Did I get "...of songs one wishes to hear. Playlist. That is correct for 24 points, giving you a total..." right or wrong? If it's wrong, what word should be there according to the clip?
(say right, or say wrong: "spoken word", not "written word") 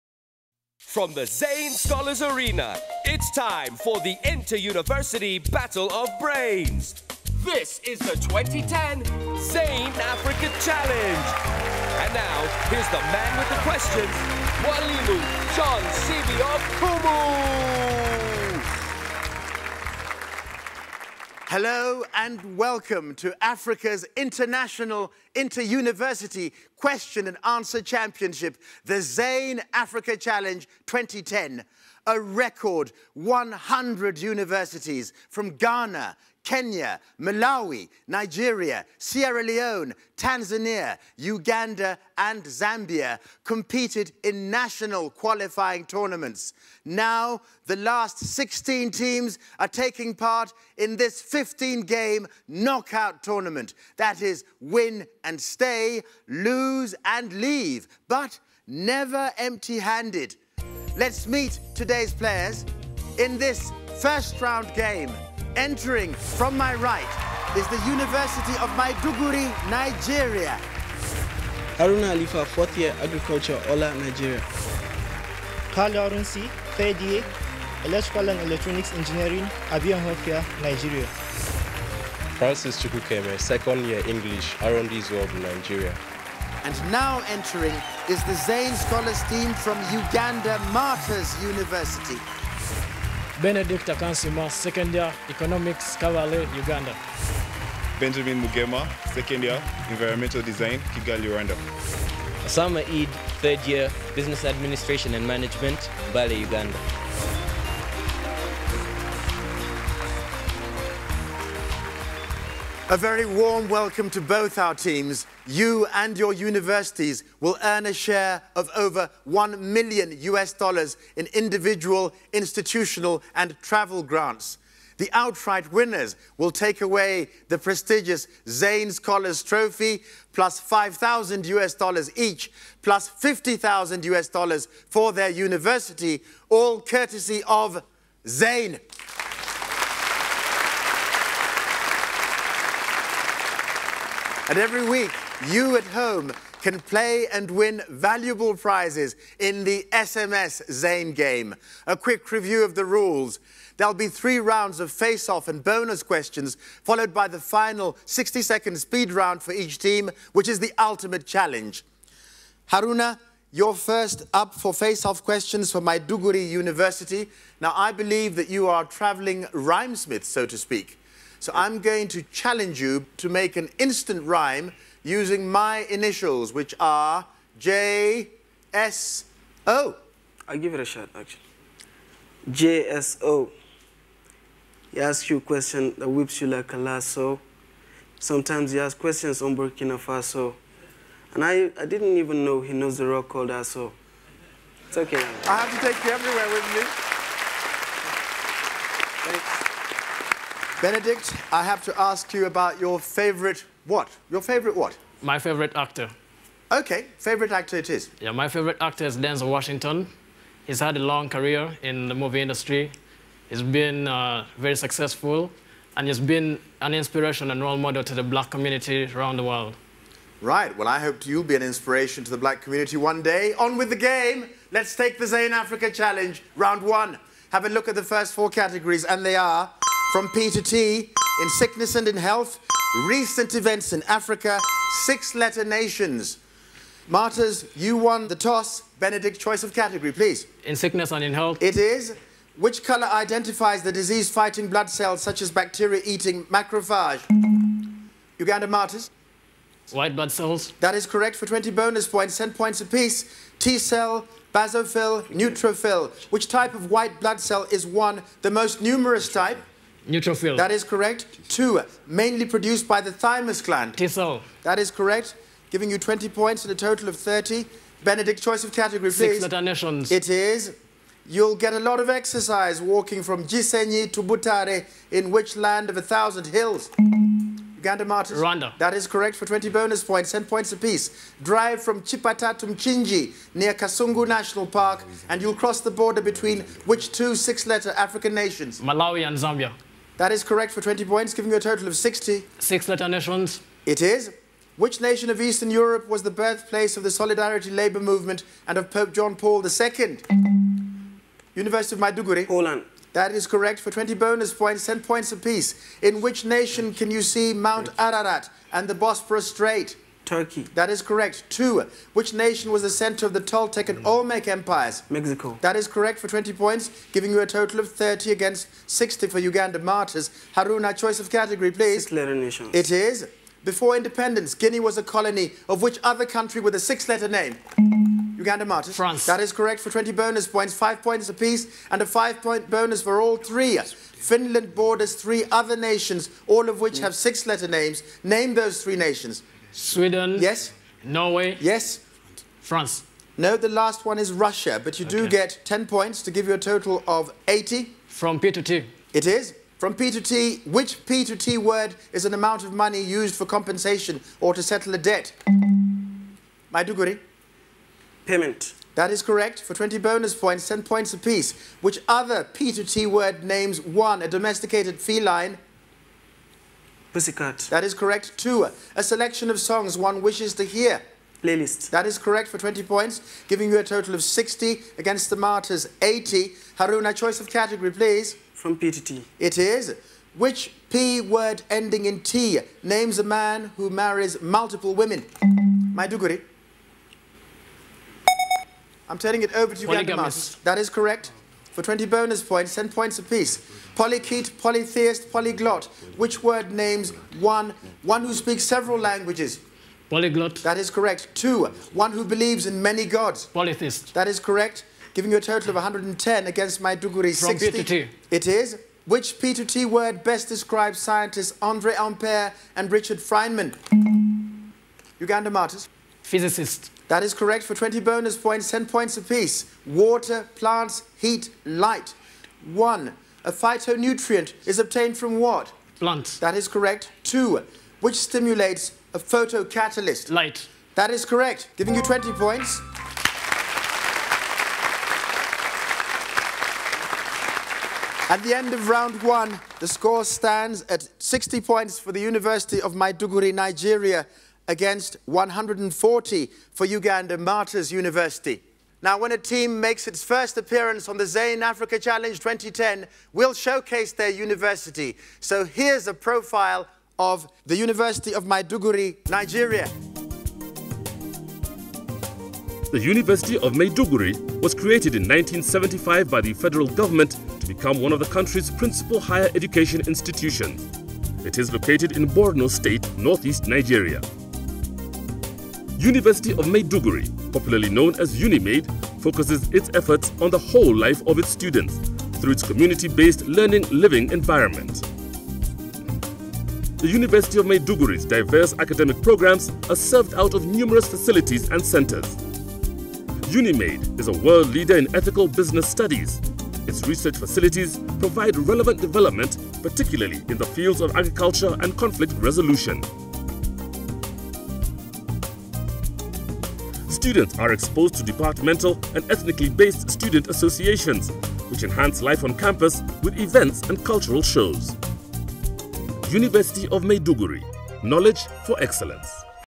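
wrong: "20", not "24".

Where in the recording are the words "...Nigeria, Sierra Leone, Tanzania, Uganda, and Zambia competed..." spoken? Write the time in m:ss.
0:38.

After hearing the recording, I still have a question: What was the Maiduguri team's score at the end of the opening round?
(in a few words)
60.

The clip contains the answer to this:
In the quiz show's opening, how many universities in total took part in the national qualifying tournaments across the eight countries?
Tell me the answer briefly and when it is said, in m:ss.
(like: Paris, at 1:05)
100, at 0:33.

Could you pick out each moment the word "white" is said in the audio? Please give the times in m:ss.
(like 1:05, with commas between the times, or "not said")
4:09, 4:16.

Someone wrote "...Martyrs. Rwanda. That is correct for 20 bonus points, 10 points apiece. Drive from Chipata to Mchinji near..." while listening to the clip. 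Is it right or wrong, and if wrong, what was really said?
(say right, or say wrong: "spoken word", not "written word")
right.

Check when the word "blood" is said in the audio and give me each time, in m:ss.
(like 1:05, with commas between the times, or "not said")
4:04, 4:10, 4:17.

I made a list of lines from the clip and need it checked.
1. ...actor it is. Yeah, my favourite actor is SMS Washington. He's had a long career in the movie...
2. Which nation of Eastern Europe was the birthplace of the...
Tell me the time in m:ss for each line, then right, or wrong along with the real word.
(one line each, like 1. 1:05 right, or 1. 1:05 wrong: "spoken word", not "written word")
1. 3:27 wrong: "Denzel", not "SMS"
2. 4:54 right.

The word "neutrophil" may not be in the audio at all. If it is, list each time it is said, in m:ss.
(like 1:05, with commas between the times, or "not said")
4:15, 4:20.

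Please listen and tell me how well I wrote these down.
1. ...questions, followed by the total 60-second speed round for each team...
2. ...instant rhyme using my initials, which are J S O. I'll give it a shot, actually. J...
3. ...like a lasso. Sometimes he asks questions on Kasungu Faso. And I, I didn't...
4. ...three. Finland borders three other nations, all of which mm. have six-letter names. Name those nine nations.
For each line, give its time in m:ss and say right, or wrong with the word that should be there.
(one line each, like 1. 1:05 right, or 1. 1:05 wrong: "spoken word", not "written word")
1. 2:36 wrong: "final", not "total"
2. 2:53 right
3. 3:06 wrong: "Burkina", not "Kasungu"
4. 5:33 wrong: "three", not "nine".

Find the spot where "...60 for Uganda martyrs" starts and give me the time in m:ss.
5:18.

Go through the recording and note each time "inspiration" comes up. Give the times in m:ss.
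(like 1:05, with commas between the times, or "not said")
3:36, 3:41.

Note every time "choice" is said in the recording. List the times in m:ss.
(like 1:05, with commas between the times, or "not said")
3:59, 4:28, 5:20, 6:17.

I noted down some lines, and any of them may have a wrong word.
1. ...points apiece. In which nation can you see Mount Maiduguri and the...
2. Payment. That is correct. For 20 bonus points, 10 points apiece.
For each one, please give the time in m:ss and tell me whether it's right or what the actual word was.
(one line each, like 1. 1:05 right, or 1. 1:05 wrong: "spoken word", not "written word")
1. 5:05 wrong: "Ararat", not "Maiduguri"
2. 5:58 right.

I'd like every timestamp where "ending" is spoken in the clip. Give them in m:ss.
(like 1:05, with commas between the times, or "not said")
6:21.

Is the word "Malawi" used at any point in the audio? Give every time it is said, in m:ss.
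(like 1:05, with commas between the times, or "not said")
0:37, 4:48.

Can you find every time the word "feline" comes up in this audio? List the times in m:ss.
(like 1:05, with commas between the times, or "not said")
6:04.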